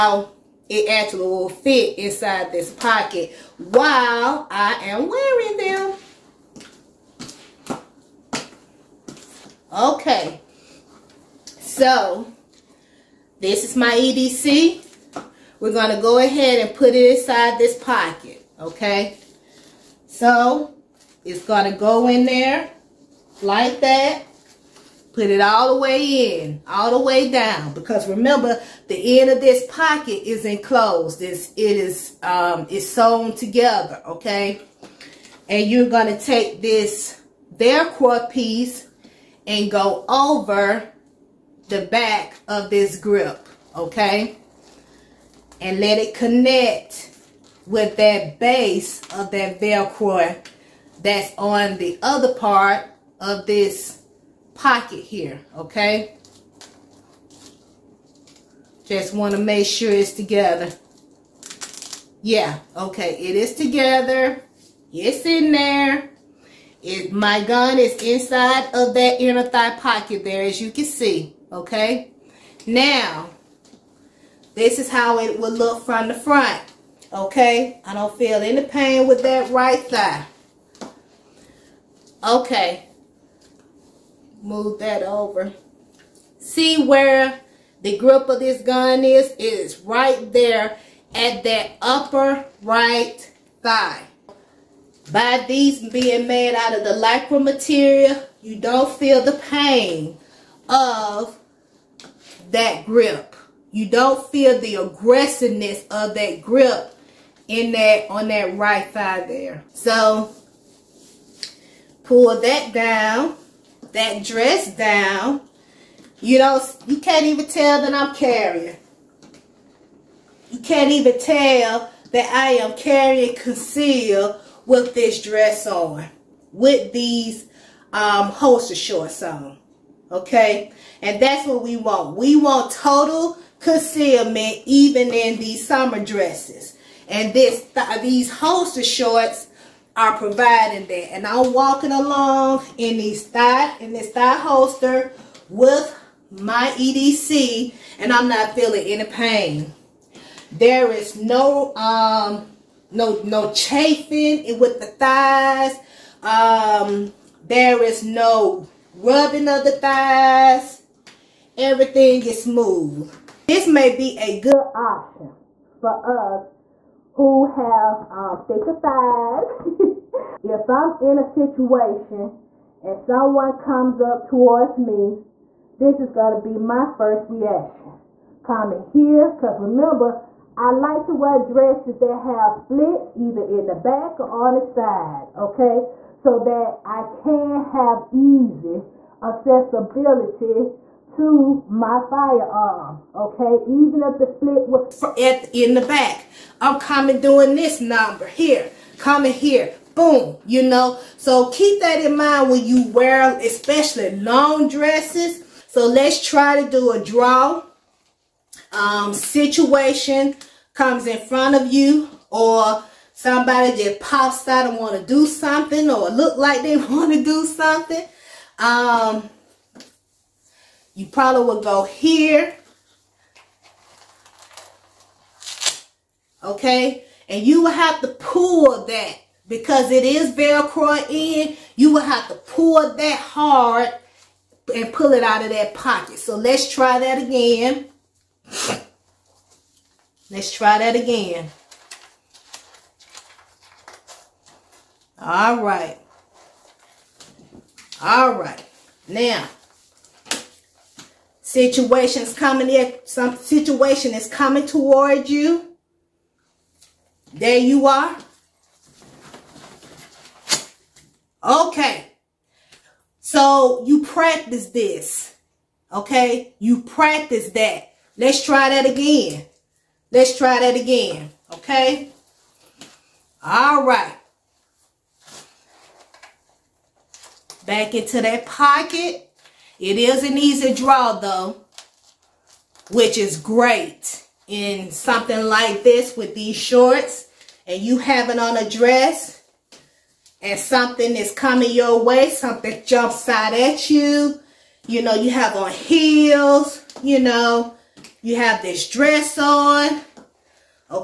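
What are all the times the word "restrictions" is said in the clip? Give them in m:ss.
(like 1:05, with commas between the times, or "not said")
not said.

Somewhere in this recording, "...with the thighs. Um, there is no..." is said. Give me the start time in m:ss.
2:34.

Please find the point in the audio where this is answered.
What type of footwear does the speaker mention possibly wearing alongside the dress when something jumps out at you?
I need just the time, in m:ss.
4:55.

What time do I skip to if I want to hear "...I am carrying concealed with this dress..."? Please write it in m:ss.
2:02.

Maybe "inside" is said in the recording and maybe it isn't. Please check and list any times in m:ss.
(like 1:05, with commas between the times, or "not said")
0:01, 0:17, 1:08.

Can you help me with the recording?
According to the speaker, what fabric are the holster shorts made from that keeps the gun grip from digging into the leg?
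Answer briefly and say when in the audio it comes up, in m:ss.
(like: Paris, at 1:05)
lycra, at 1:36.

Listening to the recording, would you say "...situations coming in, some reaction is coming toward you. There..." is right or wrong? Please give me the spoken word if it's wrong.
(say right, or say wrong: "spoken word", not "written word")
wrong: "situation", not "reaction".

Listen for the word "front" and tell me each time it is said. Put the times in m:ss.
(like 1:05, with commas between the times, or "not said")
1:16, 3:31.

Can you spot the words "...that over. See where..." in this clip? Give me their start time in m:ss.
1:24.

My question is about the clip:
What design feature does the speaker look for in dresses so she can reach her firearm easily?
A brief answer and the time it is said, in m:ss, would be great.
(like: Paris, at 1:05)
splits, at 3:02.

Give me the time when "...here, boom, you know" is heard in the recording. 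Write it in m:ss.
3:19.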